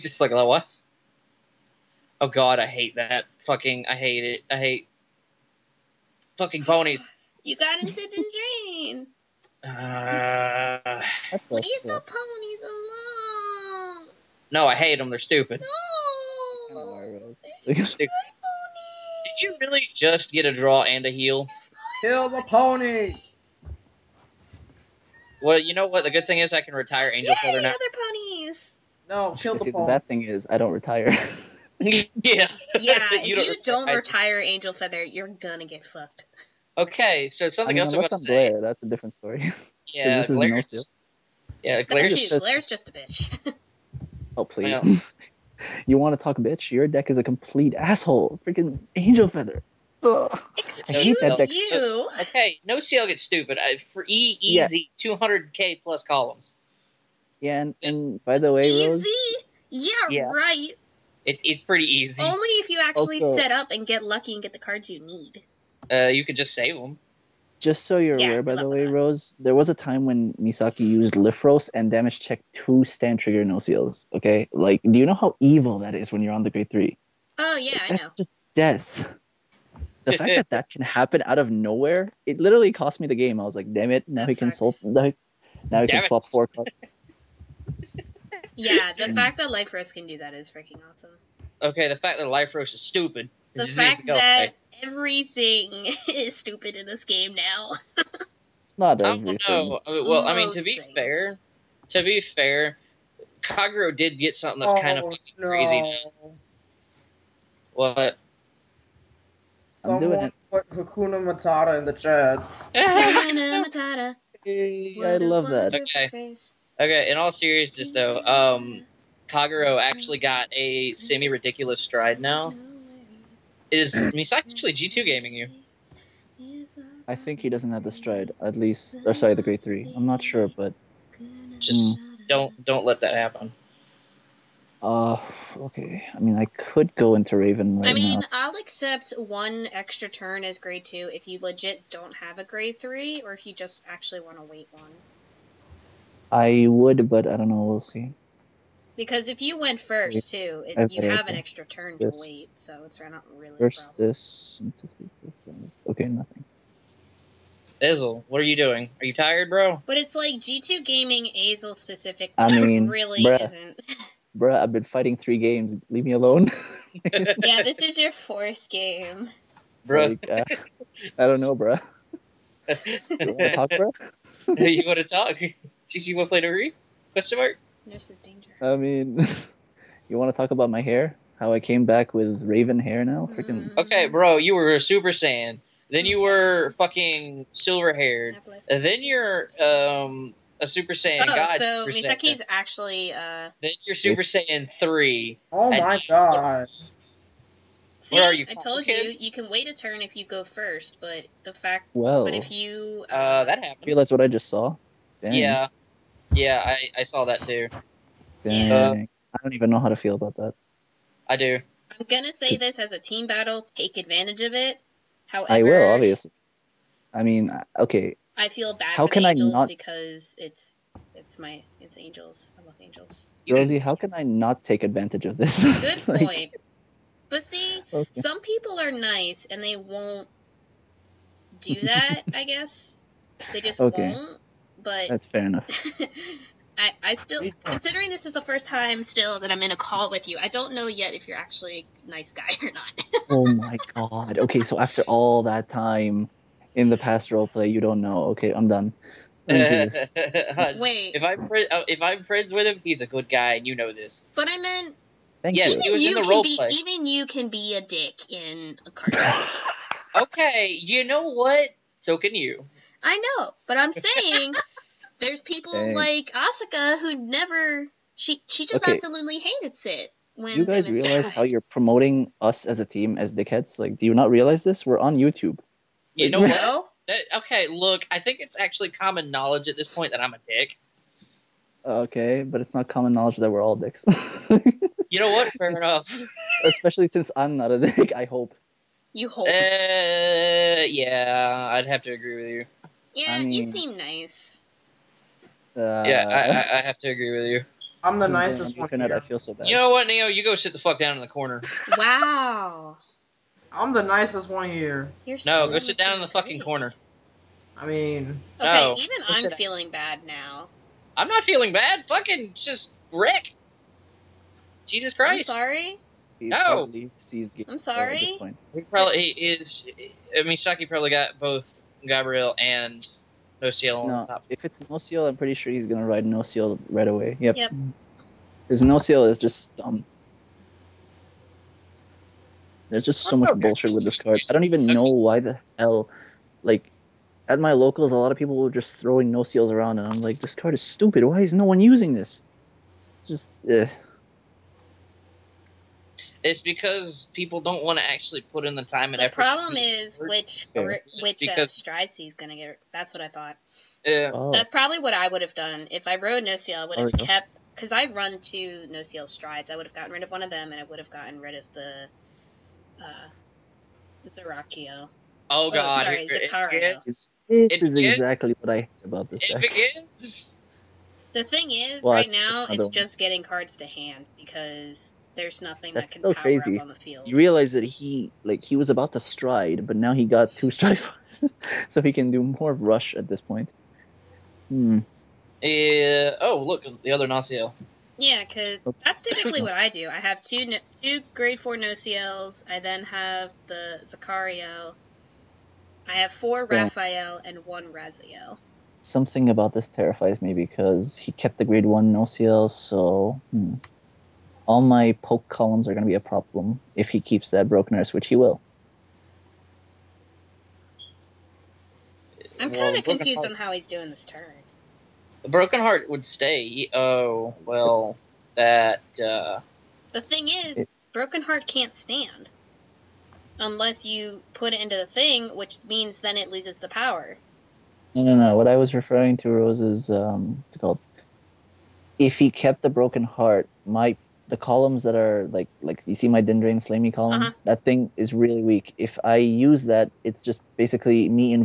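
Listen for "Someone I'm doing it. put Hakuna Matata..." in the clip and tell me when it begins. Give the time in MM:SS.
01:49.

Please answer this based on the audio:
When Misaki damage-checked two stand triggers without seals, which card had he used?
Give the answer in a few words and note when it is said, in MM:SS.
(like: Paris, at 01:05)
Lifros, at 01:11.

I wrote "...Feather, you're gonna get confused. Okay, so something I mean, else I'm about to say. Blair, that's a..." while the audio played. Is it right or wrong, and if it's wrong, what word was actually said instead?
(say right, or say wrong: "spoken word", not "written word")
wrong: "fucked", not "confused".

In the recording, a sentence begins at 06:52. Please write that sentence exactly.
I'm kind of well, confused on how he's doing this turn.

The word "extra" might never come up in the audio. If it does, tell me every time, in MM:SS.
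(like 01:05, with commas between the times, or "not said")
02:19, 02:31.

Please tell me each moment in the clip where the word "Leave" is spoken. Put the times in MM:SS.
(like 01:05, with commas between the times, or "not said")
00:11, 02:45.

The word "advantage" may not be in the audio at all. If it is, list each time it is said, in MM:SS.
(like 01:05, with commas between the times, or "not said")
03:33, 03:44.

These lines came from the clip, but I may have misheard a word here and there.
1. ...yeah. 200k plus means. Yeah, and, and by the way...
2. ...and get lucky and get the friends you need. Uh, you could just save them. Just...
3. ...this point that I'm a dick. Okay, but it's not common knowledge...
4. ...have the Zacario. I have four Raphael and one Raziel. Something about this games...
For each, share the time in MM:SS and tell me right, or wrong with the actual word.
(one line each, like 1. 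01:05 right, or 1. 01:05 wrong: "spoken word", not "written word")
1. 00:55 wrong: "columns", not "means"
2. 01:03 wrong: "cards", not "friends"
3. 04:39 right
4. 06:33 wrong: "terrifies", not "games".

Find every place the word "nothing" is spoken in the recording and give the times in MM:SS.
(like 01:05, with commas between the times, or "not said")
02:36, 06:15.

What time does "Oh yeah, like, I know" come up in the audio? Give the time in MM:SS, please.
01:17.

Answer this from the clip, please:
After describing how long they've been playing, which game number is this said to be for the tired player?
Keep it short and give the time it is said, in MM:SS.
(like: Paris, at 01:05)
4th, at 02:48.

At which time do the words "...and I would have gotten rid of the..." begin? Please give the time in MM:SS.
06:00.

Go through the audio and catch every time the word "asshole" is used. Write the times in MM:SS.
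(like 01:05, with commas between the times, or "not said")
00:47.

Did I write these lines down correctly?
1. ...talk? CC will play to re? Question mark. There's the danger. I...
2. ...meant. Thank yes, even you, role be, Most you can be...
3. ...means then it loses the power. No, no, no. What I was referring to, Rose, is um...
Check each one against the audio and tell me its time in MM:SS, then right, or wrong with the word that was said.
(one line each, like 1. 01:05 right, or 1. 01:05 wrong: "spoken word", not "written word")
1. 02:55 right
2. 04:14 wrong: "Even", not "Most"
3. 07:05 right.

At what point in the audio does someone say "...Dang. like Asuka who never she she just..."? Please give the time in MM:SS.
04:25.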